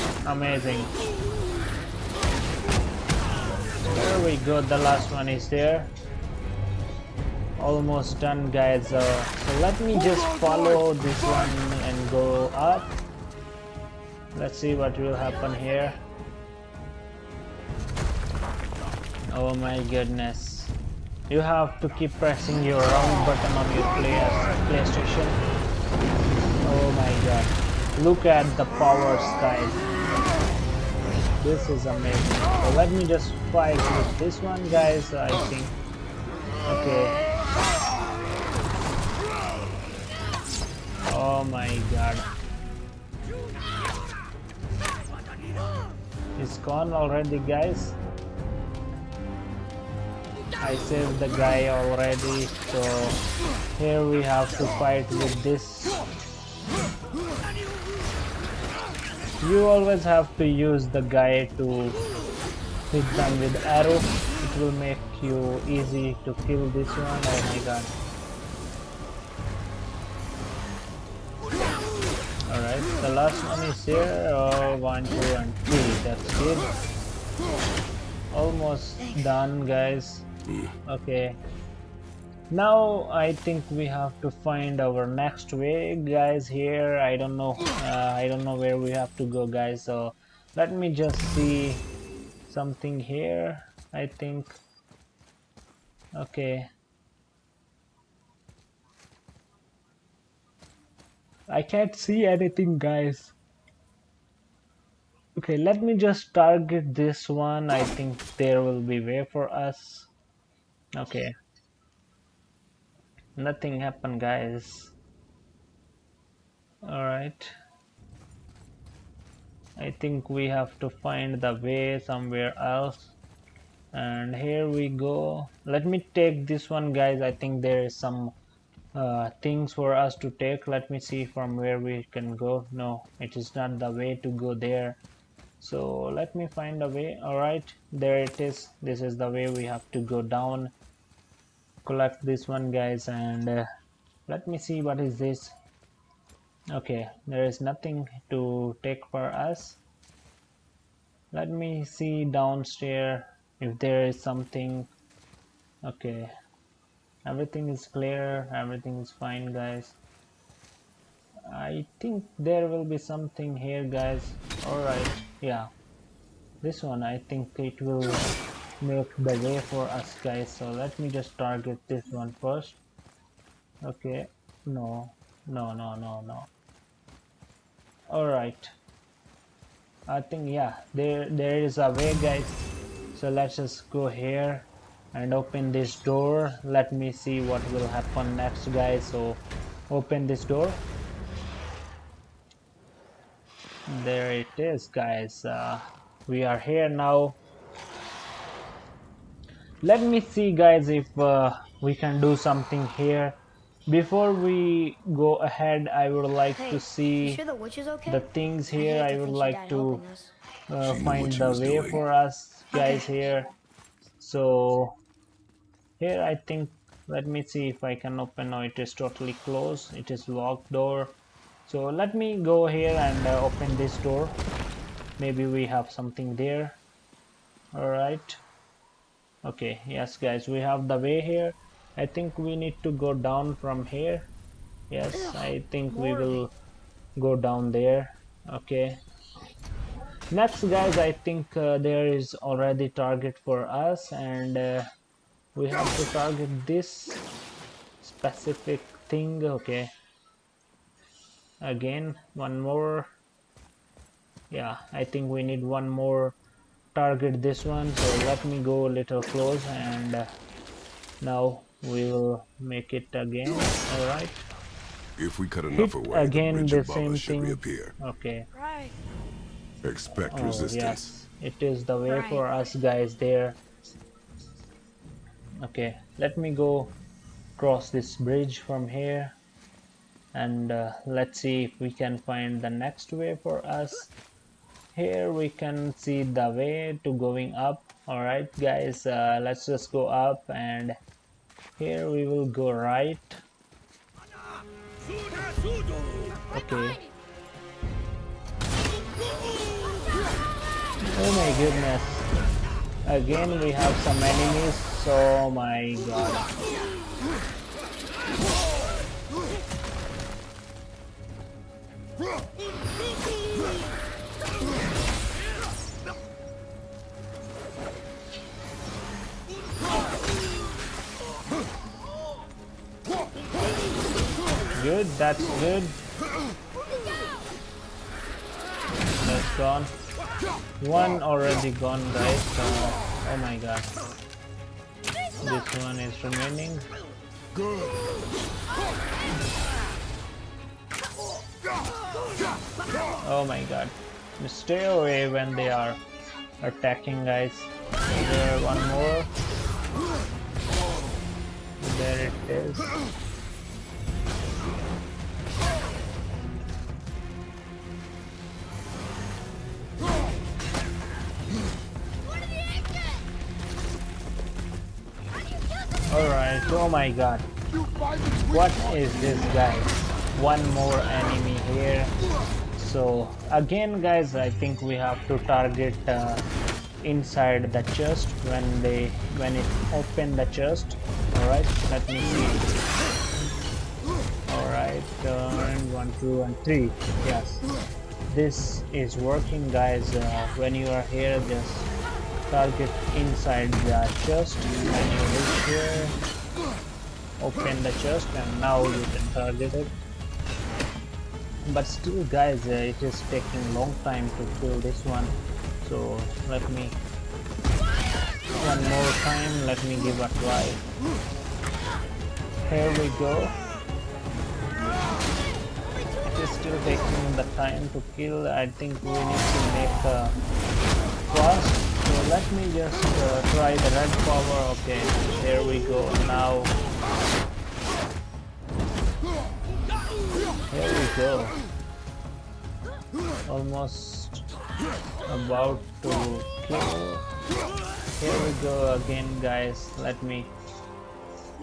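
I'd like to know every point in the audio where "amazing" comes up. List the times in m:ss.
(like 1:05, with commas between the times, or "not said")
0:00, 0:31.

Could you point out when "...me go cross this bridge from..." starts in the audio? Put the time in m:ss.
4:36.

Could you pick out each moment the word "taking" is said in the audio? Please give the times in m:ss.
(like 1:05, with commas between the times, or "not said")
6:43, 6:56.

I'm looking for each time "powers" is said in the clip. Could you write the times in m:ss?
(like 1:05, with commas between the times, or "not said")
0:28, 7:04.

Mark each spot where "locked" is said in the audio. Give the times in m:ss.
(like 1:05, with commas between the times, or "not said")
3:40.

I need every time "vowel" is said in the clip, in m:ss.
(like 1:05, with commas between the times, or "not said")
not said.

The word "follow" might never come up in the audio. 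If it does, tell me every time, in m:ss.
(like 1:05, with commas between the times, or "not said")
0:10.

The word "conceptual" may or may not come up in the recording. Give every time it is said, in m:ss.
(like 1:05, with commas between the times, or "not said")
not said.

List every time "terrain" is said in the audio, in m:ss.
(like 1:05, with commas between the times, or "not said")
not said.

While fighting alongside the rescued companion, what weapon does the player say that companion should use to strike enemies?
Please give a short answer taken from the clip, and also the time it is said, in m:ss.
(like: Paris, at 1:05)
arrow, at 1:03.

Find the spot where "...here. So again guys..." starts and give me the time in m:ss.
6:11.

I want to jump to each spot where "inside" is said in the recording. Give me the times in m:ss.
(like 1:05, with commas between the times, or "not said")
6:17, 6:33.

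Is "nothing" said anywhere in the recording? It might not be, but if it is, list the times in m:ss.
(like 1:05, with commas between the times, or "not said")
1:53, 2:27.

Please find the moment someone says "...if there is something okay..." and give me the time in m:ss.
2:33.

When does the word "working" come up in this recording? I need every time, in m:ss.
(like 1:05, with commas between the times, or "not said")
6:29.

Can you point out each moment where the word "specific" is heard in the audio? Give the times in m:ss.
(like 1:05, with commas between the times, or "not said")
4:08.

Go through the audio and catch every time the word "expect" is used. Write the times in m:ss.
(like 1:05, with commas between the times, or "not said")
4:29.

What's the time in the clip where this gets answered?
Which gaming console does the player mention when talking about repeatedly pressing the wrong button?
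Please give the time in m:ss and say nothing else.
0:24.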